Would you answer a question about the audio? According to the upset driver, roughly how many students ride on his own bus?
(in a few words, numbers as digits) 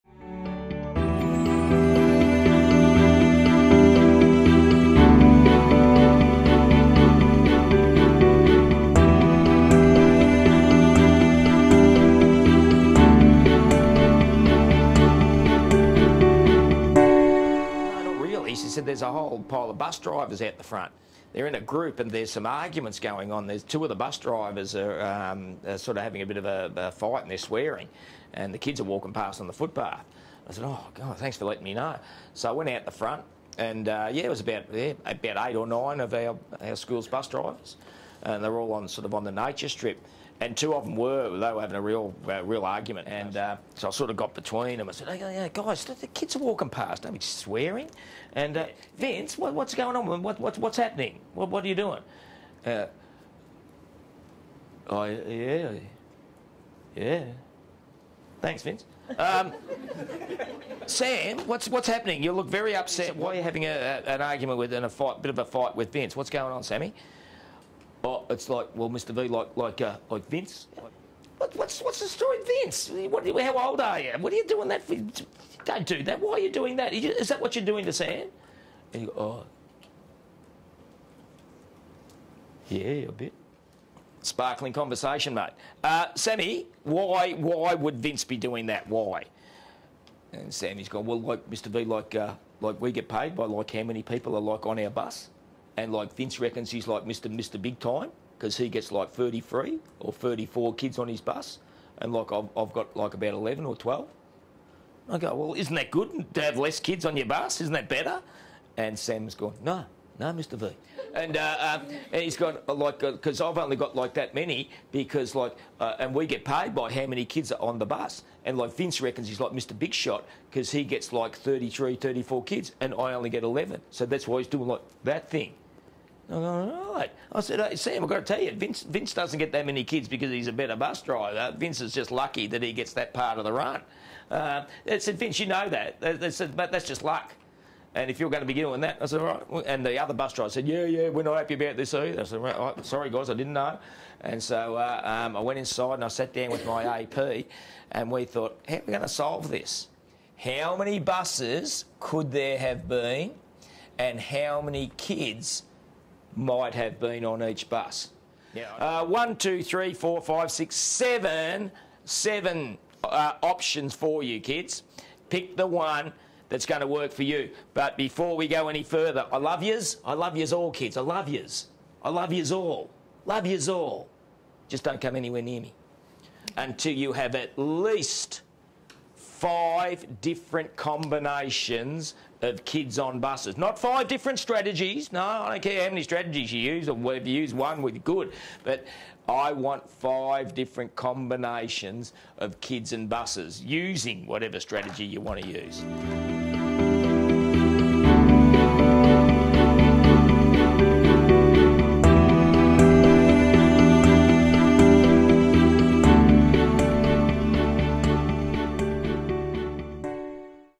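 11 or 12.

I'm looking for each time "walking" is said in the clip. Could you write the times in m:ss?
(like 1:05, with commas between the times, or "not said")
0:28, 0:46.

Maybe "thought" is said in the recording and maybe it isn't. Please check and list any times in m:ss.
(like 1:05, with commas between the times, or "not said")
2:28.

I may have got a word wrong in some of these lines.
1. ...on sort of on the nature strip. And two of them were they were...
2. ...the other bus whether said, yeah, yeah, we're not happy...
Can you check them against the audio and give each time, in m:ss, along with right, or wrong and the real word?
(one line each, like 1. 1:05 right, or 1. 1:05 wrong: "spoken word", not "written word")
1. 0:38 right
2. 2:19 wrong: "driver", not "whether".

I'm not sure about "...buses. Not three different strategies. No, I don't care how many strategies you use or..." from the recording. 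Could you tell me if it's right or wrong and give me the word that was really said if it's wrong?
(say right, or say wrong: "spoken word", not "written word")
wrong: "five", not "three".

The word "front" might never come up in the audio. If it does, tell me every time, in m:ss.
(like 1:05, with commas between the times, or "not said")
0:20, 0:32.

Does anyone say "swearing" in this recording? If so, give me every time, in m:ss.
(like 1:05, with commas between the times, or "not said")
0:27, 0:47.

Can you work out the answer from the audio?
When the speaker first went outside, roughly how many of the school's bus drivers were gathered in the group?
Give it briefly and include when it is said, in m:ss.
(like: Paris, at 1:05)
8 or 9, at 0:35.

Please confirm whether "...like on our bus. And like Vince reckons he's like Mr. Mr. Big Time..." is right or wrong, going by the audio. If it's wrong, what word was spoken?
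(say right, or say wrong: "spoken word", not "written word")
right.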